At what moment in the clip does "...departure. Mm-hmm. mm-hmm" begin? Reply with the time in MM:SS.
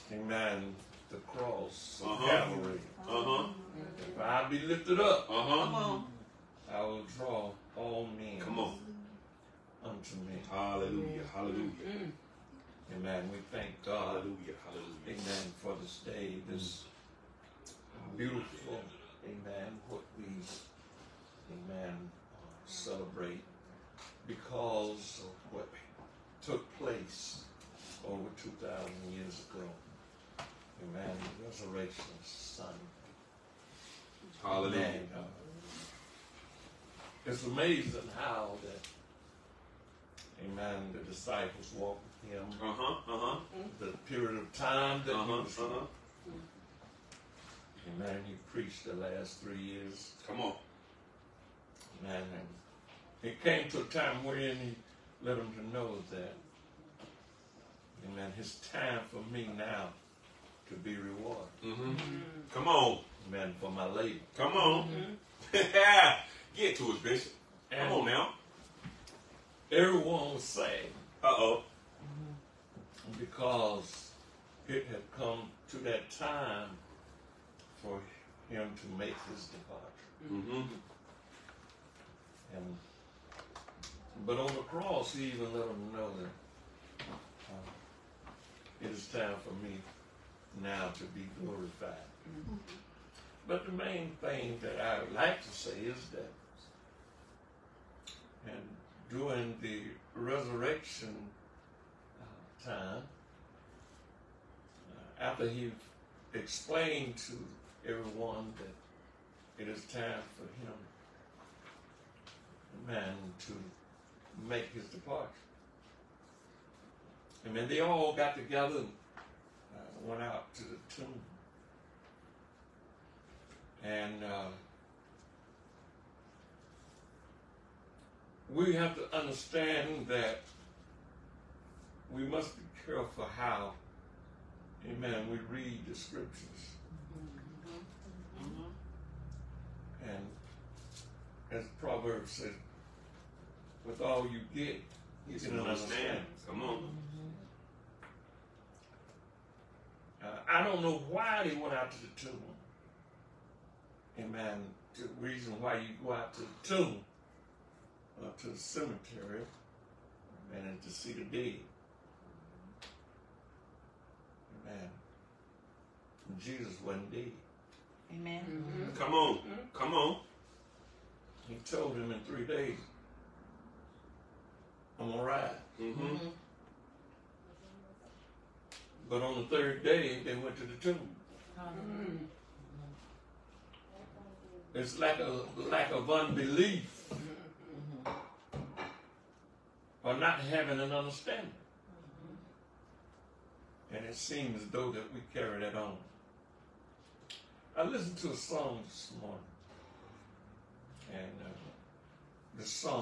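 01:19.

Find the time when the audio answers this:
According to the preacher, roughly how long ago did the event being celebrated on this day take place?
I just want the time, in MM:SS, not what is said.
00:28.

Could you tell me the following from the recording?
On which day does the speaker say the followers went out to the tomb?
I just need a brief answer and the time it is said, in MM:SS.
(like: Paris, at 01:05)
third day, at 02:59.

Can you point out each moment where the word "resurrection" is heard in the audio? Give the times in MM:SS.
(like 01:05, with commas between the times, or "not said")
00:31, 01:40.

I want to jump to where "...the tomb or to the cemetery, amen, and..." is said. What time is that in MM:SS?
02:36.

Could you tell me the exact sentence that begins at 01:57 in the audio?
And then they all got together and uh, went out to the tomb.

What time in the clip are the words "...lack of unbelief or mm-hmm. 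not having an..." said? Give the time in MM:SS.
03:05.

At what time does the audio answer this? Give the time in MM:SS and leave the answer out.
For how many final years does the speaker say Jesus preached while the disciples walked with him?
00:48.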